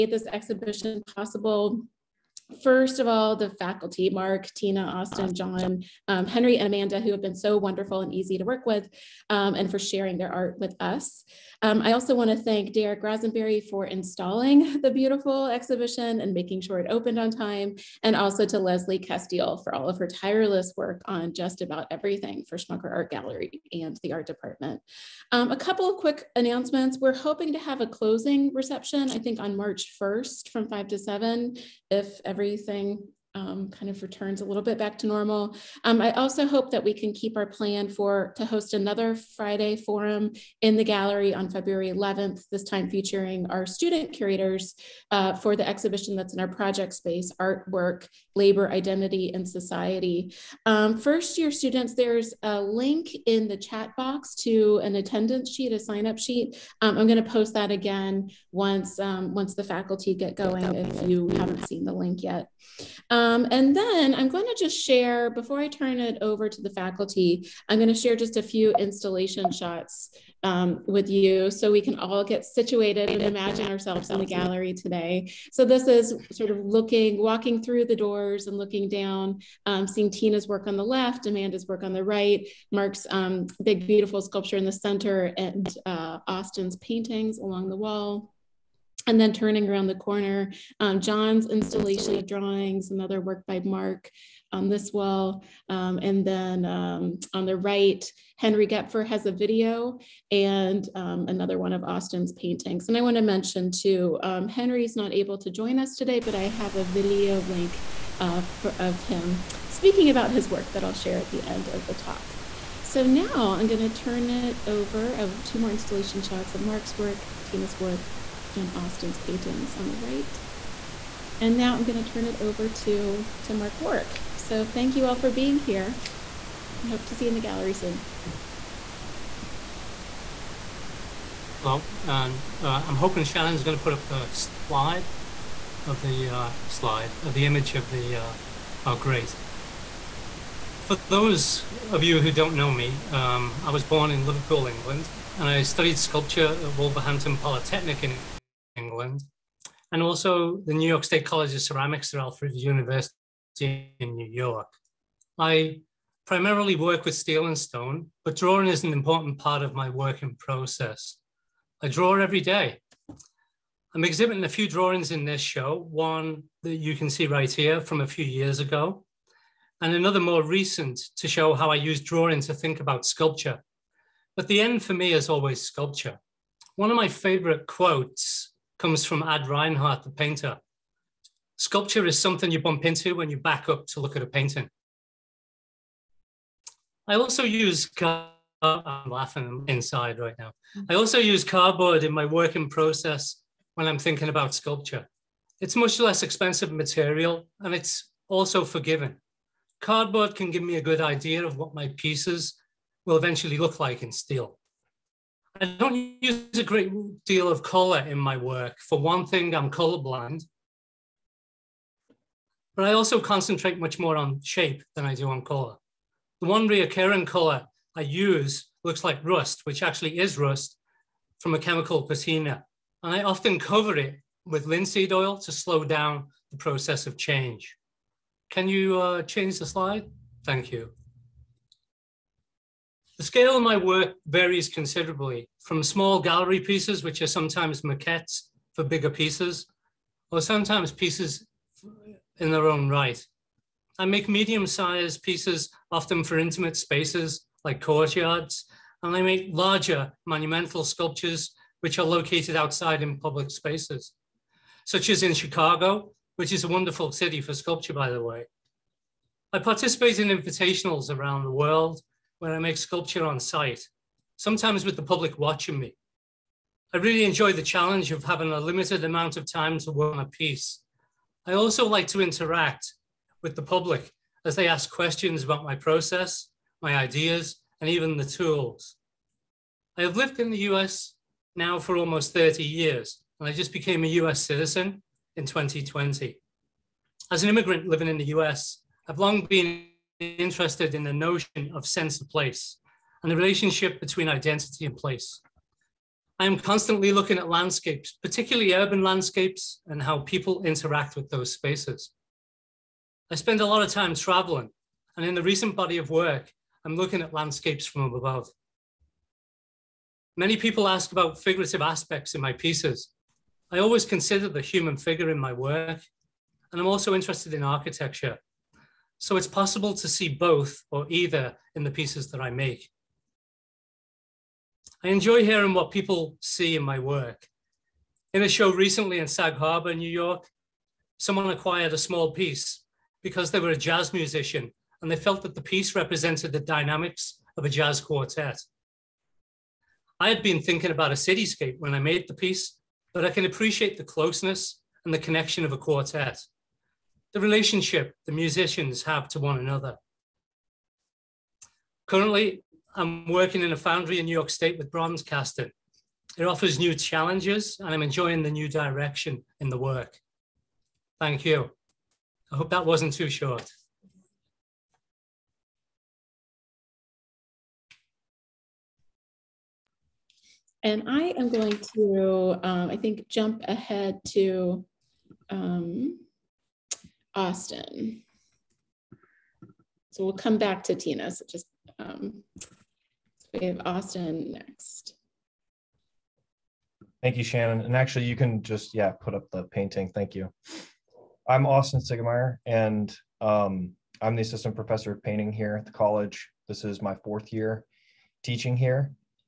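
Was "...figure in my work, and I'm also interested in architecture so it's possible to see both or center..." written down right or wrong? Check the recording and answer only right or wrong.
wrong.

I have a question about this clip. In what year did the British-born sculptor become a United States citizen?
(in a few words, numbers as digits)
2020.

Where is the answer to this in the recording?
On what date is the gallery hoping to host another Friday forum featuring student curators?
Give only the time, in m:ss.
0:41.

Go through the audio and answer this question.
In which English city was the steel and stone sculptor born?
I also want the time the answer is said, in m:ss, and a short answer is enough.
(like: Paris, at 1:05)
Liverpool, at 2:24.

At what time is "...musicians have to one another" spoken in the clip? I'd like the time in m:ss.
5:48.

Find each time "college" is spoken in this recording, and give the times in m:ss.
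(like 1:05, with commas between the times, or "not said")
2:31, 6:35.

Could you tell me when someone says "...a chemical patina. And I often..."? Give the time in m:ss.
3:41.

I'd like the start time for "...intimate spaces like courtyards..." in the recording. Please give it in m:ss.
4:06.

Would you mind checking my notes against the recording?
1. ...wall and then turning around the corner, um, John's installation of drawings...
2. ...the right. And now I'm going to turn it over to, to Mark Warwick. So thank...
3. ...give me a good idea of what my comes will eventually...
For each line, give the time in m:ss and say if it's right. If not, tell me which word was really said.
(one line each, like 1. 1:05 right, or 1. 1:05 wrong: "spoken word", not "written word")
1. 1:27 right
2. 1:59 right
3. 3:20 wrong: "pieces", not "comes".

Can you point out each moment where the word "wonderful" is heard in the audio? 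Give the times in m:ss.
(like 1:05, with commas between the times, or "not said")
0:07, 4:16.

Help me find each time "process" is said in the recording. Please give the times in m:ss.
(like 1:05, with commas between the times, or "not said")
2:40, 3:12, 3:46, 4:35.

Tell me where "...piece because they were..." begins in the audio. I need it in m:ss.
5:32.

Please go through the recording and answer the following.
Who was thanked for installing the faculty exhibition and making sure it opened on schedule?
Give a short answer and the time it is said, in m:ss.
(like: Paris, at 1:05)
Derek Rosenberry, at 0:12.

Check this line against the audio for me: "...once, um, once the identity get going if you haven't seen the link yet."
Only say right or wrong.
wrong.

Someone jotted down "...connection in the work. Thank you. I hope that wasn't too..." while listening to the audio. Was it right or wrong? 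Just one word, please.
wrong.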